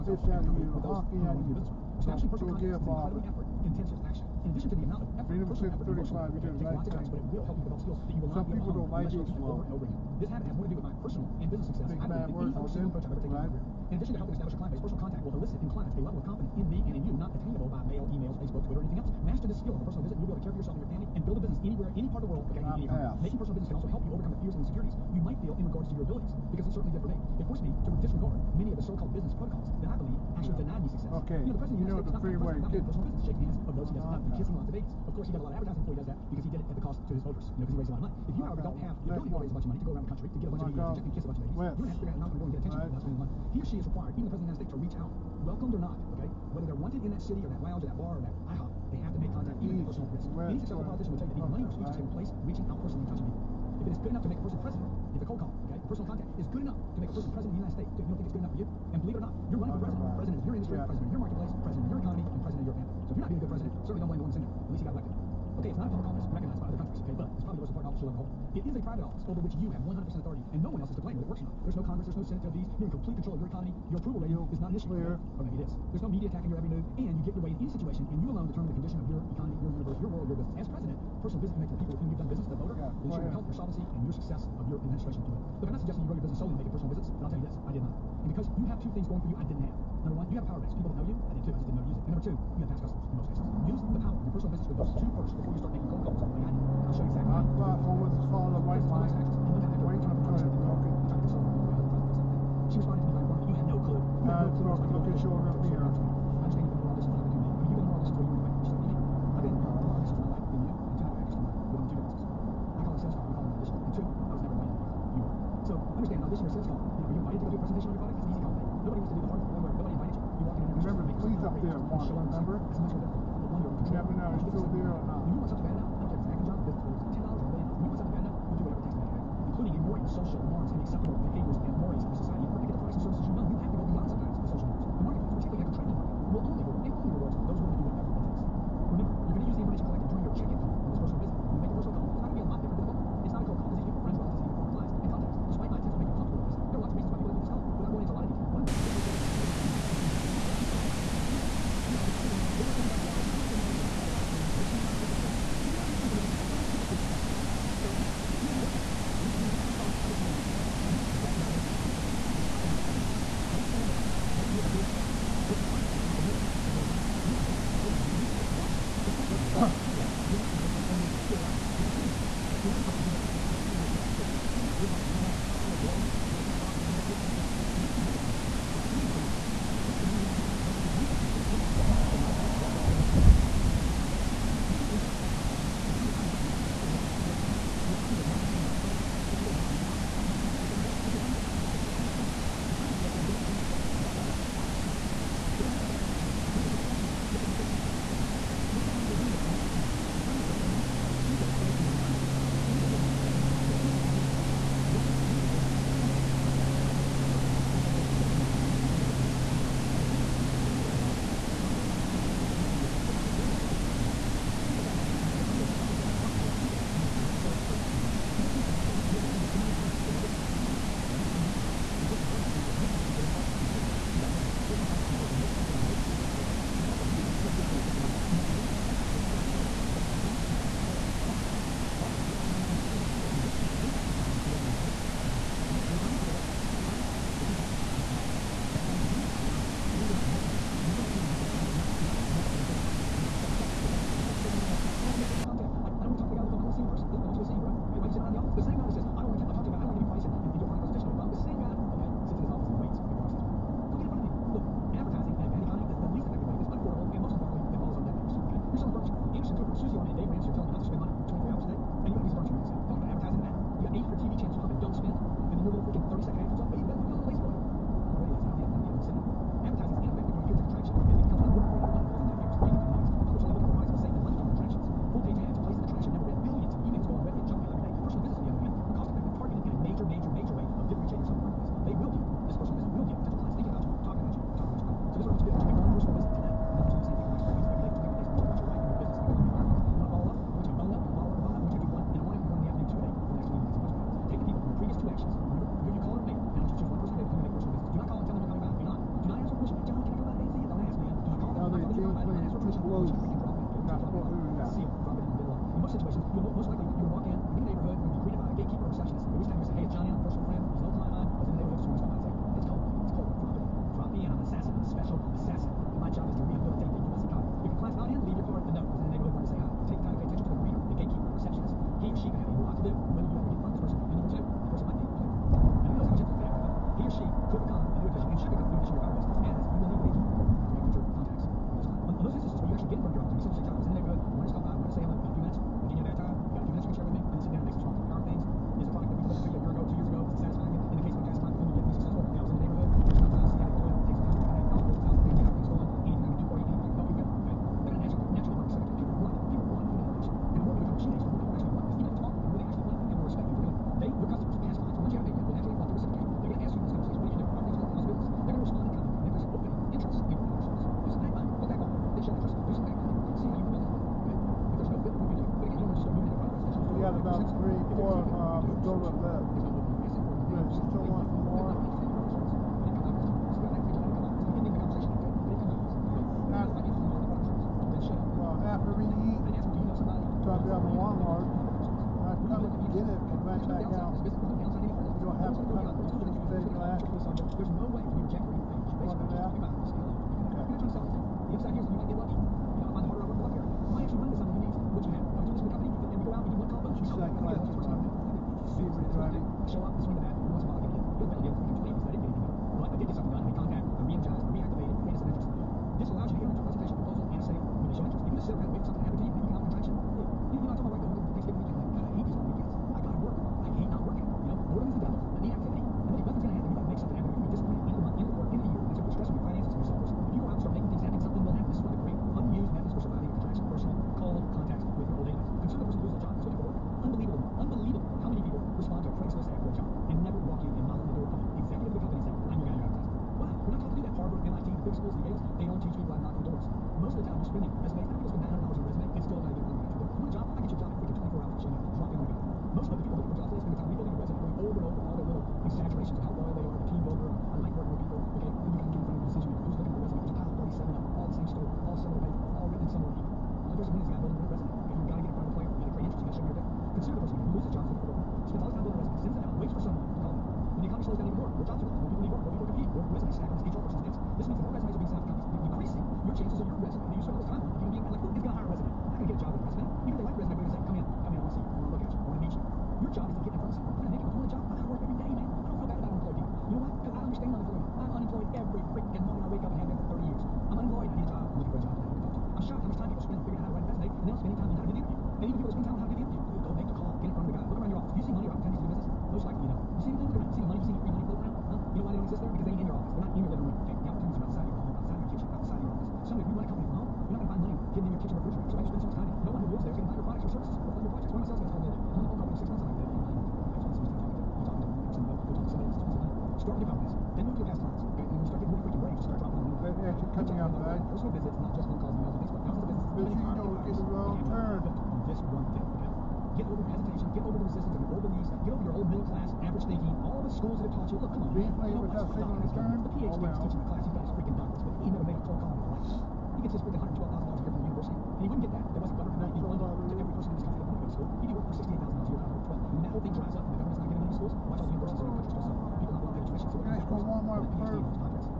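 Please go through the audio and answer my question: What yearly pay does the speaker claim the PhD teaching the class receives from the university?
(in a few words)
$112,000.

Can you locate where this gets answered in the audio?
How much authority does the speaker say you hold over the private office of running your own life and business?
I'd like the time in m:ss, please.
1:09.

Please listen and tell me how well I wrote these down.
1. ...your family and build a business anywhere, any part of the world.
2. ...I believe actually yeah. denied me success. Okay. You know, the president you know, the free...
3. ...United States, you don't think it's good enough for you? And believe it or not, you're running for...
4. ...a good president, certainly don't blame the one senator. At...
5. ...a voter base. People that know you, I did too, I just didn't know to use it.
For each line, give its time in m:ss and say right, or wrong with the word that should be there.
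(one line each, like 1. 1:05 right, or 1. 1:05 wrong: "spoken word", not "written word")
1. 0:20 right
2. 0:29 right
3. 0:57 right
4. 1:03 right
5. 1:30 wrong: "power", not "voter".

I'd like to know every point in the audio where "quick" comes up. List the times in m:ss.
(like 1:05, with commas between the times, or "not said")
8:29.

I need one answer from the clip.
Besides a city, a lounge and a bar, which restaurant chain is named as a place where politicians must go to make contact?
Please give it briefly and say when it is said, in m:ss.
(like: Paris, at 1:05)
IHOP, at 0:48.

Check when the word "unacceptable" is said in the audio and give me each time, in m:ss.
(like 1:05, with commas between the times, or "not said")
2:10.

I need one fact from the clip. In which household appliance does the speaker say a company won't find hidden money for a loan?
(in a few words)
Kitchen refrigerator.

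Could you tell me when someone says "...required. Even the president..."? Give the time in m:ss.
0:43.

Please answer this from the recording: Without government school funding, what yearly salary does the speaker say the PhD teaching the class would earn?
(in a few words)
$16,000.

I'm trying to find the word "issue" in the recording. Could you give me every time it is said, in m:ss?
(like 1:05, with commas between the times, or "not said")
1:14.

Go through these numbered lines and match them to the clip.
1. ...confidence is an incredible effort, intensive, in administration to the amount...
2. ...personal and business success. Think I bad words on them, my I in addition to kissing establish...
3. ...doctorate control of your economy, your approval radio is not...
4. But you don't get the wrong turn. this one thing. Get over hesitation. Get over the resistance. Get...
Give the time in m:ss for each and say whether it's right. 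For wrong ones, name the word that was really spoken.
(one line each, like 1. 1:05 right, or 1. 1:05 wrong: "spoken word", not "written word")
1. 0:02 wrong: "addition", not "administration"
2. 0:10 wrong: "helping", not "kissing"
3. 1:12 wrong: "complete", not "doctorate"
4. 8:33 right.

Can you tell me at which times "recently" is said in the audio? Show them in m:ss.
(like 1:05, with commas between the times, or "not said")
not said.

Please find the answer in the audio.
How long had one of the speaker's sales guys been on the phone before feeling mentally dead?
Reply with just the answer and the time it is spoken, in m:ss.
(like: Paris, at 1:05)
6 months, at 8:23.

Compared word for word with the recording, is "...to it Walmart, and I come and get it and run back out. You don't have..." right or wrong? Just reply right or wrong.
right.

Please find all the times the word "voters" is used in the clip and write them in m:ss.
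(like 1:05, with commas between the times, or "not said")
0:37, 1:22.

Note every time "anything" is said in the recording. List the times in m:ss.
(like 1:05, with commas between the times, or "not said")
0:18, 6:28.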